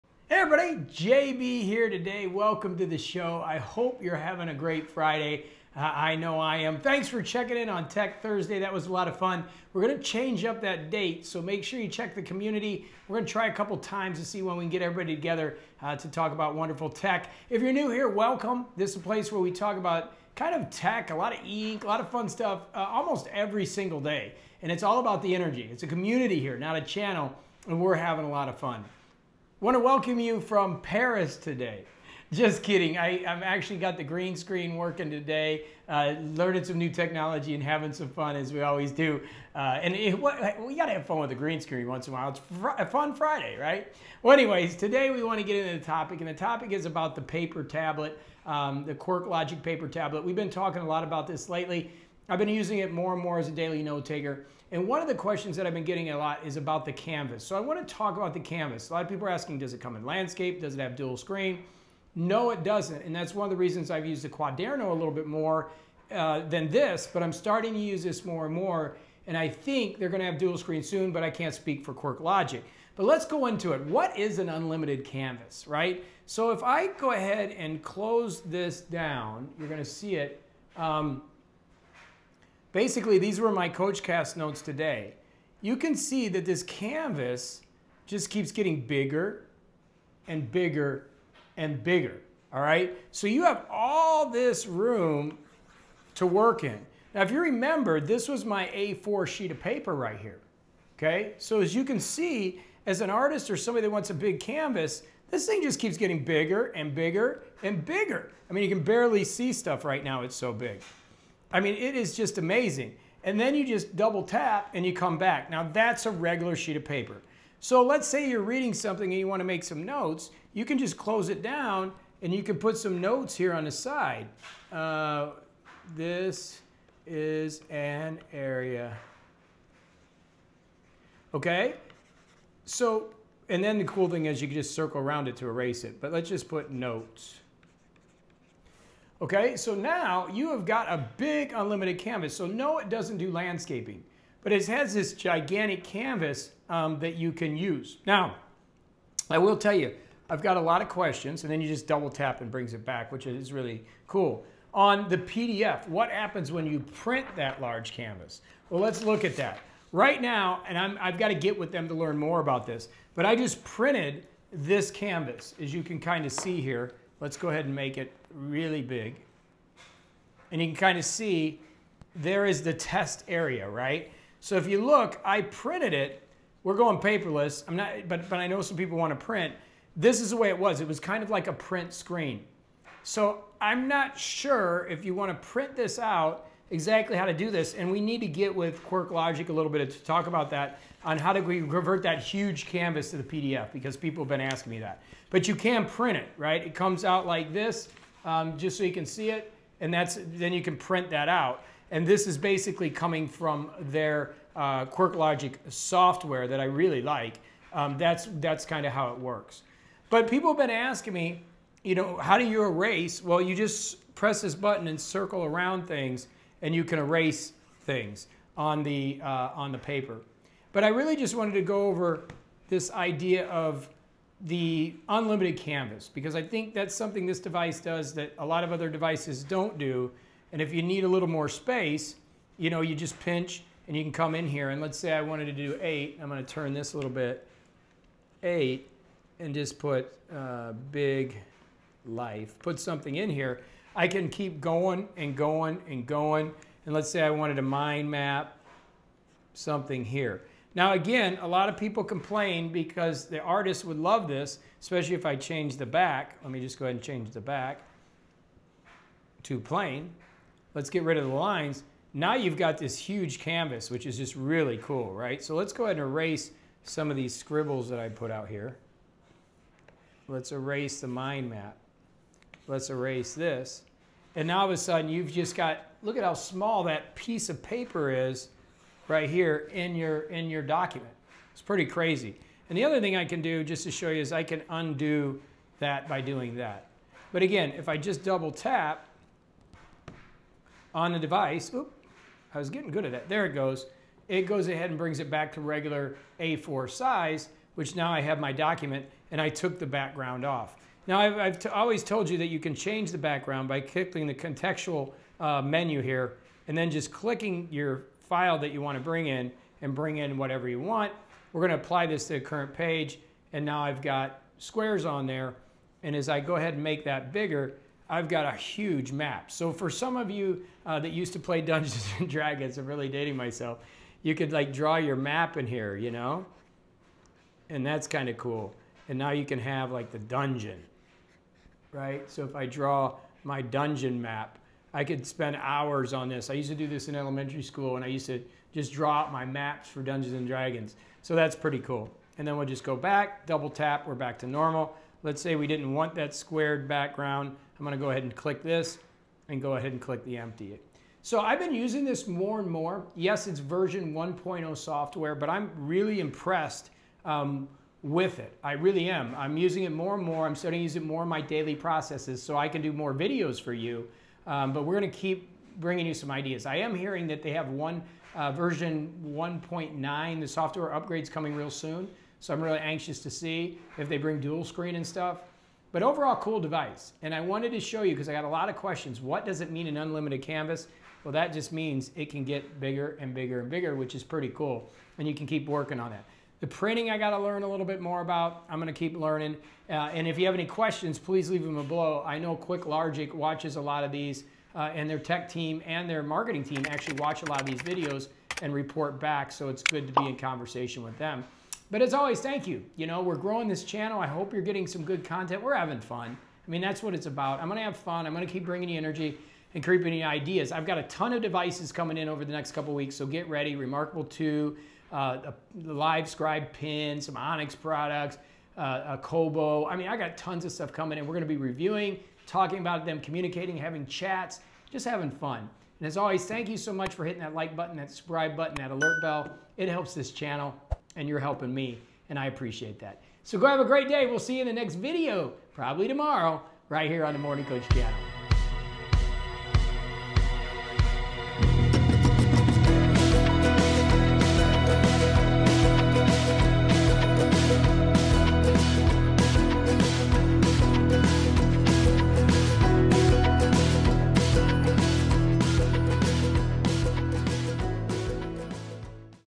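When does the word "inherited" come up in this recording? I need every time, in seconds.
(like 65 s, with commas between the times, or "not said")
not said.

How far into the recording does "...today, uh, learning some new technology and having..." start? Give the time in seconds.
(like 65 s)
35 s.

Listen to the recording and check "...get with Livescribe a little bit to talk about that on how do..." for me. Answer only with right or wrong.
wrong.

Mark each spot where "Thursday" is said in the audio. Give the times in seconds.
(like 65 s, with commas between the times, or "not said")
8 s.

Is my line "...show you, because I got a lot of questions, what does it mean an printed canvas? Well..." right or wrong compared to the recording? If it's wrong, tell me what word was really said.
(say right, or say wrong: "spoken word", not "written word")
wrong: "unlimited", not "printed".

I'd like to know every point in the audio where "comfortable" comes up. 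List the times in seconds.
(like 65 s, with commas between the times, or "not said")
not said.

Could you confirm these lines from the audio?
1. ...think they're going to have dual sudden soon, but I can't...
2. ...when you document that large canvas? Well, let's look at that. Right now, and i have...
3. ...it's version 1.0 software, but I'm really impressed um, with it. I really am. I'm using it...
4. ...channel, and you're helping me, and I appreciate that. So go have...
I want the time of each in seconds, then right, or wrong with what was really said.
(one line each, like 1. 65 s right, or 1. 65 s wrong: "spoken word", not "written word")
1. 69 s wrong: "screen", not "sudden"
2. 156 s wrong: "print", not "document"
3. 353 s right
4. 430 s right.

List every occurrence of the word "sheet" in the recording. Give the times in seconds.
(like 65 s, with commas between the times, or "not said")
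99 s, 116 s.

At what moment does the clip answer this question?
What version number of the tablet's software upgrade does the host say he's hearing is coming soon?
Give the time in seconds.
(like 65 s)
368 s.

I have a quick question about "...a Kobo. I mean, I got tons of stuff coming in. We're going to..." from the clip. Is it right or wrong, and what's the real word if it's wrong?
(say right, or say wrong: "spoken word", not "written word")
right.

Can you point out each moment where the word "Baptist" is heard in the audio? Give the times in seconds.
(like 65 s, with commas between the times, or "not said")
not said.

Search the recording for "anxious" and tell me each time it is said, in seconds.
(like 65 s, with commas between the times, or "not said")
372 s.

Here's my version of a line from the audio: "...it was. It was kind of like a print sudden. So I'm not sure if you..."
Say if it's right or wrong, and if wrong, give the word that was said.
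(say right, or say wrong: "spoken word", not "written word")
wrong: "screen", not "sudden".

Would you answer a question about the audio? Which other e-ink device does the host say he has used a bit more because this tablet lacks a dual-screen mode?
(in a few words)
Quaderno.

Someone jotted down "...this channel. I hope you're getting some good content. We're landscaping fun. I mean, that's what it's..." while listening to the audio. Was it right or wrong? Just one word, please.
wrong.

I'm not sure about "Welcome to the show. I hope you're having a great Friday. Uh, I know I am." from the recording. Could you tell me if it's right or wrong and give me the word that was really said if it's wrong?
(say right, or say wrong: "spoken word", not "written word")
right.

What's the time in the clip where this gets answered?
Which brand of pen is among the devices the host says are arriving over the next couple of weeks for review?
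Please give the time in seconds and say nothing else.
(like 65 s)
415 s.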